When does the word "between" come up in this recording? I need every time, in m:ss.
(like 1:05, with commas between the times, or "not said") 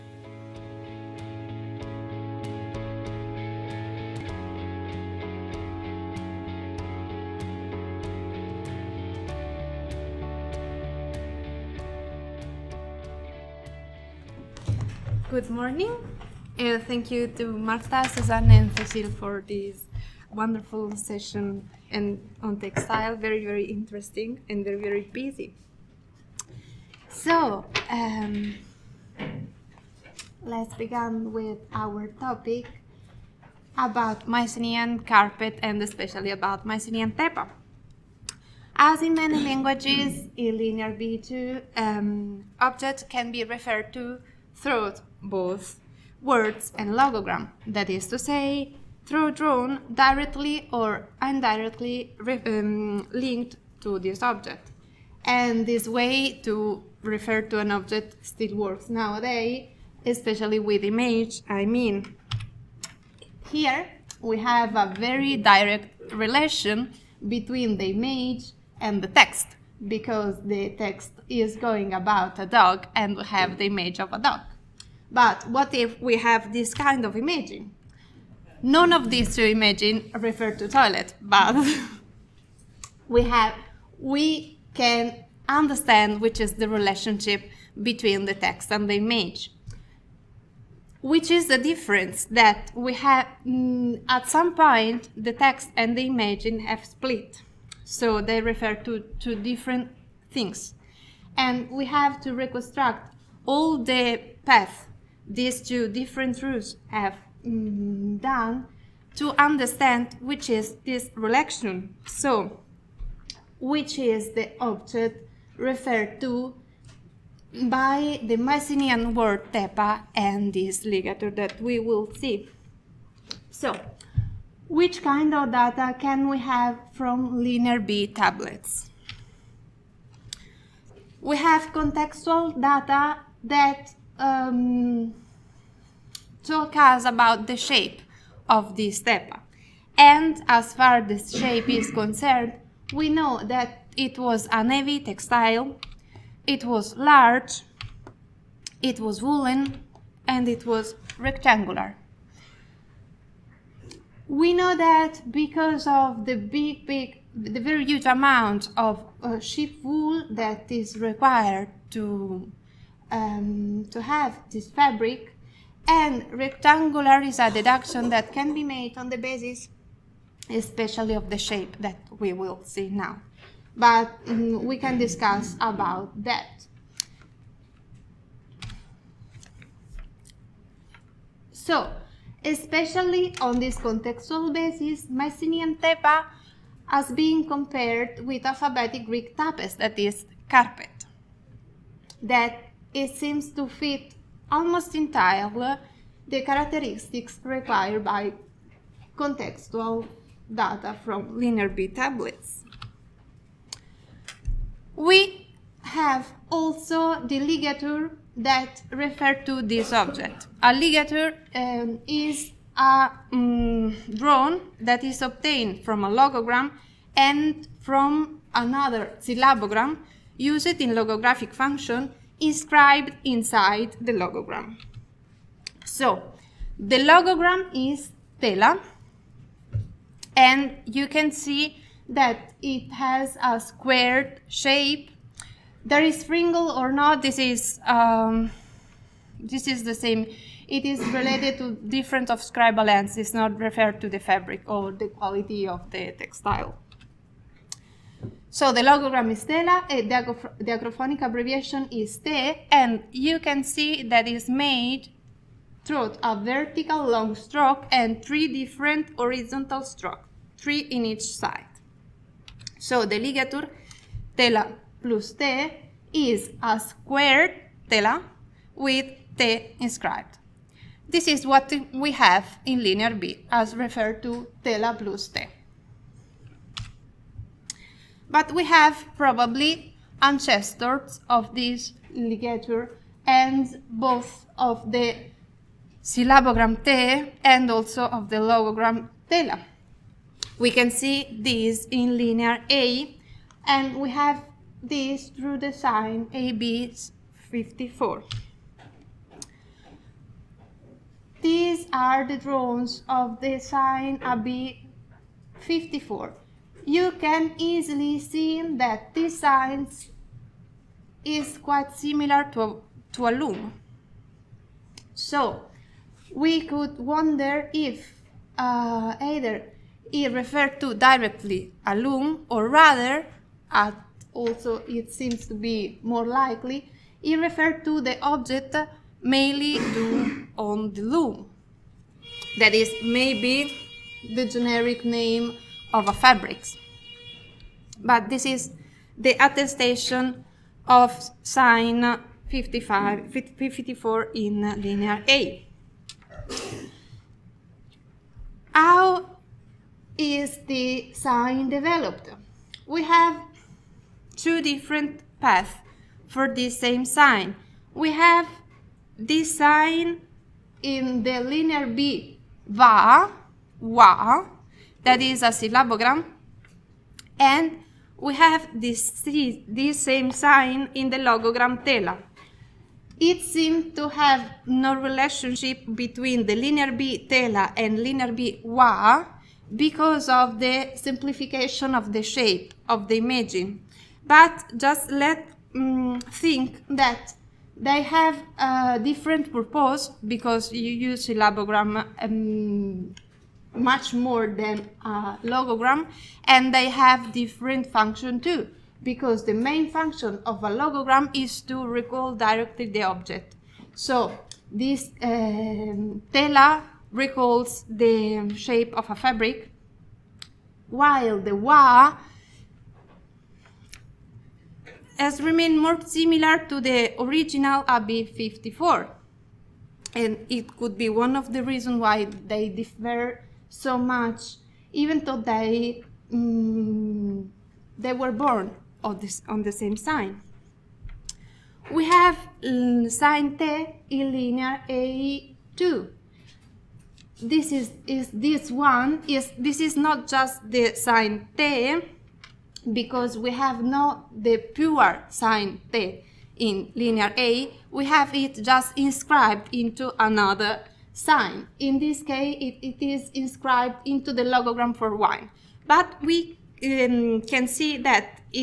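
1:07, 1:27, 6:15.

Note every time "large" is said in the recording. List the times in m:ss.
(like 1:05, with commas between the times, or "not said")
2:26.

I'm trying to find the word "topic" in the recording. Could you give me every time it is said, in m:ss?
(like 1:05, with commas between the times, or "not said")
0:32.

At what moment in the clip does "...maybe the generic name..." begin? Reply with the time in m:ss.
5:33.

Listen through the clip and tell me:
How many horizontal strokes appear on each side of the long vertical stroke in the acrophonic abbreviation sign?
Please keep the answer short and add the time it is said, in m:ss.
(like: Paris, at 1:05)
3, at 4:20.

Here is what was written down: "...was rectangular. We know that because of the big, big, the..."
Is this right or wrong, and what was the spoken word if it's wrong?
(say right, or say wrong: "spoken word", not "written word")
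right.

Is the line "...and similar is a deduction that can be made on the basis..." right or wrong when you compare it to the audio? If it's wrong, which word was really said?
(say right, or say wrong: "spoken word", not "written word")
wrong: "rectangular", not "similar".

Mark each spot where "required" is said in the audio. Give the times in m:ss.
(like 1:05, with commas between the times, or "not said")
2:40, 3:17.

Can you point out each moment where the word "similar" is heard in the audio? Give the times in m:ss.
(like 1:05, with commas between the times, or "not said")
5:11, 6:56.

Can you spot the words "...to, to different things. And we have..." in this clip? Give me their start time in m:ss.
1:38.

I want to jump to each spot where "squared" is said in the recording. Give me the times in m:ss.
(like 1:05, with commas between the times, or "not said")
3:53, 4:26.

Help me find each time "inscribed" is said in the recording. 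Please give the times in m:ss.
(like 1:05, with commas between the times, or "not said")
3:42, 4:29, 7:28, 7:33.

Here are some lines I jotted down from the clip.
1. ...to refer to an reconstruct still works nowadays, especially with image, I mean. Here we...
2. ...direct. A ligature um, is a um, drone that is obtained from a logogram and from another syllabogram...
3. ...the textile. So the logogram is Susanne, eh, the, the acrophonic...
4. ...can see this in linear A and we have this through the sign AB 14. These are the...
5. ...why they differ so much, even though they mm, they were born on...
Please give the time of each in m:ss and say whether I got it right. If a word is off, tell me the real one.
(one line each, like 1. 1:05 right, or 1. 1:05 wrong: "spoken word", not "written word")
1. 0:56 wrong: "object", not "reconstruct"
2. 3:29 wrong: "object", not "direct"
3. 4:05 wrong: "Tela", not "Susanne"
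4. 4:50 wrong: "54", not "14"
5. 7:01 right.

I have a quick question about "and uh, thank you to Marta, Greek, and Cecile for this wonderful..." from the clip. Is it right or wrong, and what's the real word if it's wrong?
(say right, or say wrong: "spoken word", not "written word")
wrong: "Susanne", not "Greek".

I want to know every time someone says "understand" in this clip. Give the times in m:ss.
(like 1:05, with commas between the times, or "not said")
1:25, 1:49.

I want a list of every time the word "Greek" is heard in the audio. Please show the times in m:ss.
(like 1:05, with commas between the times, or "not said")
3:09.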